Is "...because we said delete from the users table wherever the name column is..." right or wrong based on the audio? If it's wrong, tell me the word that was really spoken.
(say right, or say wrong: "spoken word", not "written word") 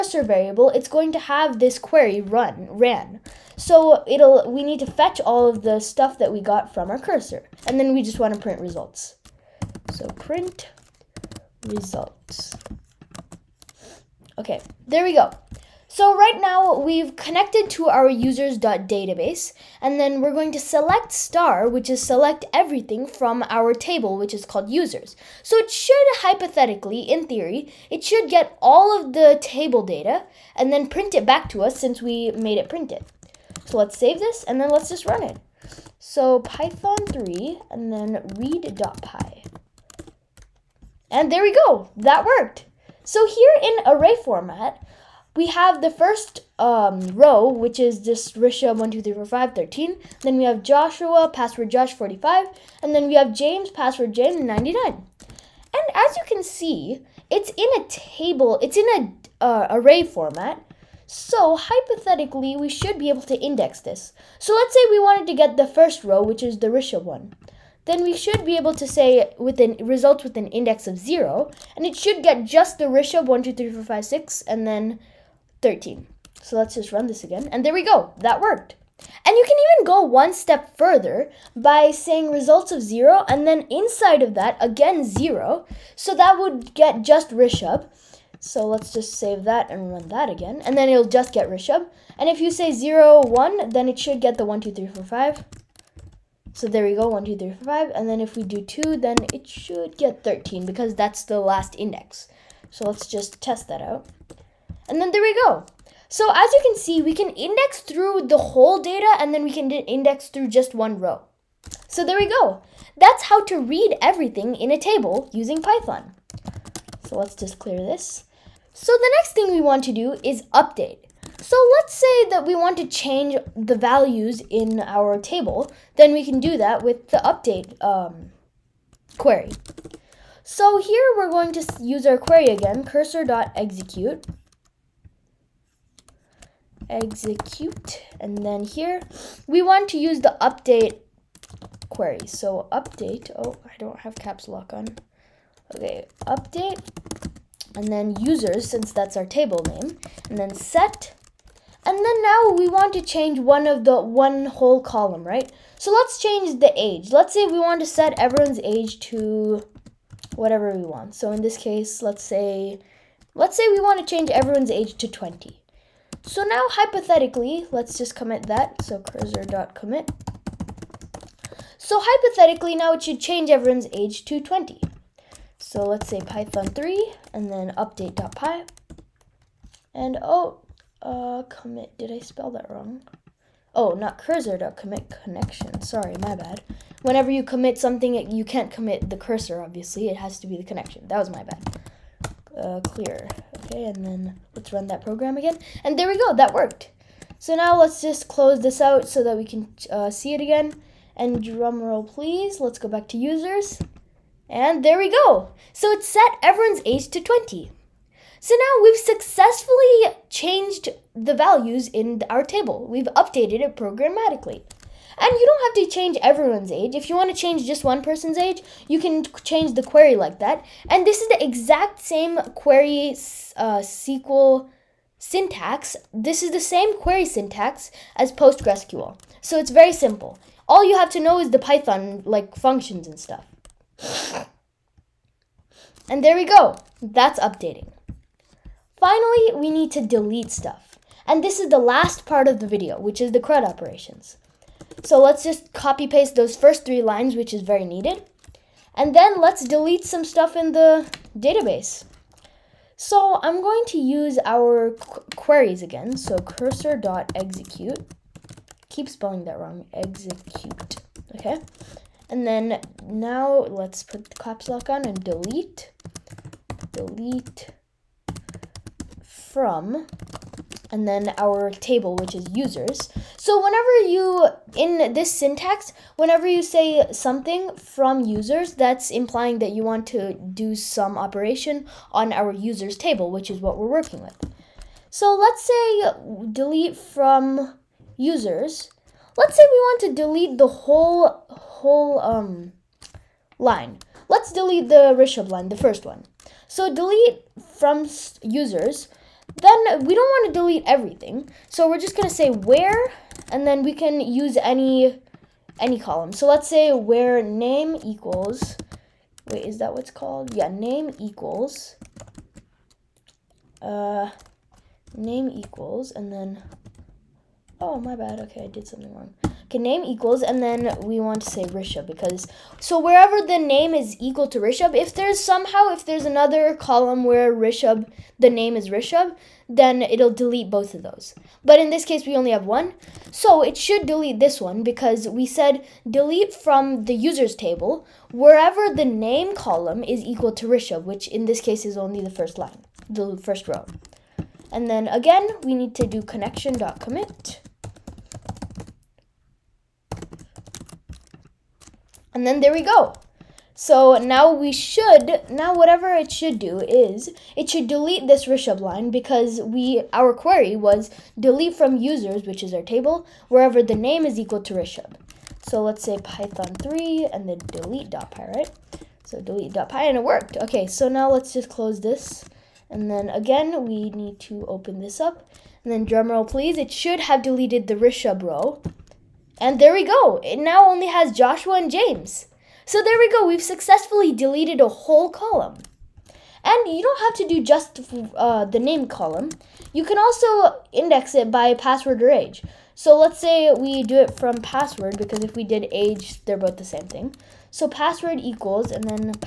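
right.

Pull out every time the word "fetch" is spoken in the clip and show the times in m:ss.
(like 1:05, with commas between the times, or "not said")
0:04.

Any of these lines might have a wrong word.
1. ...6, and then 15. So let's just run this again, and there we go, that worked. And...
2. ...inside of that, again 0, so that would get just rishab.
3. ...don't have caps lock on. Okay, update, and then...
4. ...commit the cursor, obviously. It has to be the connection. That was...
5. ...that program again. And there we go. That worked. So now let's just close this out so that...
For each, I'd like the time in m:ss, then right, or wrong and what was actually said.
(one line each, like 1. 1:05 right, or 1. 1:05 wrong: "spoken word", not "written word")
1. 1:14 wrong: "13", not "15"
2. 1:23 right
3. 2:23 right
4. 3:08 right
5. 3:14 right.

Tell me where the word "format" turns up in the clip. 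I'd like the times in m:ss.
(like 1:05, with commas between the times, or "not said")
0:44, 1:00.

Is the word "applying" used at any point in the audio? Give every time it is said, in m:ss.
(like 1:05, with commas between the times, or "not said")
not said.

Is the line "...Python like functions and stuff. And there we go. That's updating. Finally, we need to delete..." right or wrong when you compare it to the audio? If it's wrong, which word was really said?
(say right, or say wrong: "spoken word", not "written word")
right.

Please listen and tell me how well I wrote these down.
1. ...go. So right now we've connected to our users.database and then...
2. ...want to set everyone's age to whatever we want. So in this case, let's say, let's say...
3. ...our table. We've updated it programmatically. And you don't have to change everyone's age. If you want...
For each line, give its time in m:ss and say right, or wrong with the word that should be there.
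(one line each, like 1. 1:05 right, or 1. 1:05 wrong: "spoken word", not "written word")
1. 0:15 right
2. 2:37 right
3. 3:32 right.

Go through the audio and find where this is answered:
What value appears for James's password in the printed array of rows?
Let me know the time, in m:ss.
0:54.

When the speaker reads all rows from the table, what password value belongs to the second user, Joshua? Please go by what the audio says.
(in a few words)
Josh 45.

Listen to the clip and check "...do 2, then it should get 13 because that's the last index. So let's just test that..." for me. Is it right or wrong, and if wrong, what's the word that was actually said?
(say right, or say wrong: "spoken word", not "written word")
right.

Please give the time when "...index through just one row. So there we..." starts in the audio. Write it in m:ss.
1:49.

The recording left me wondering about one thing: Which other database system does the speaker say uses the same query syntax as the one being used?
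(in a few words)
PostgreSQL.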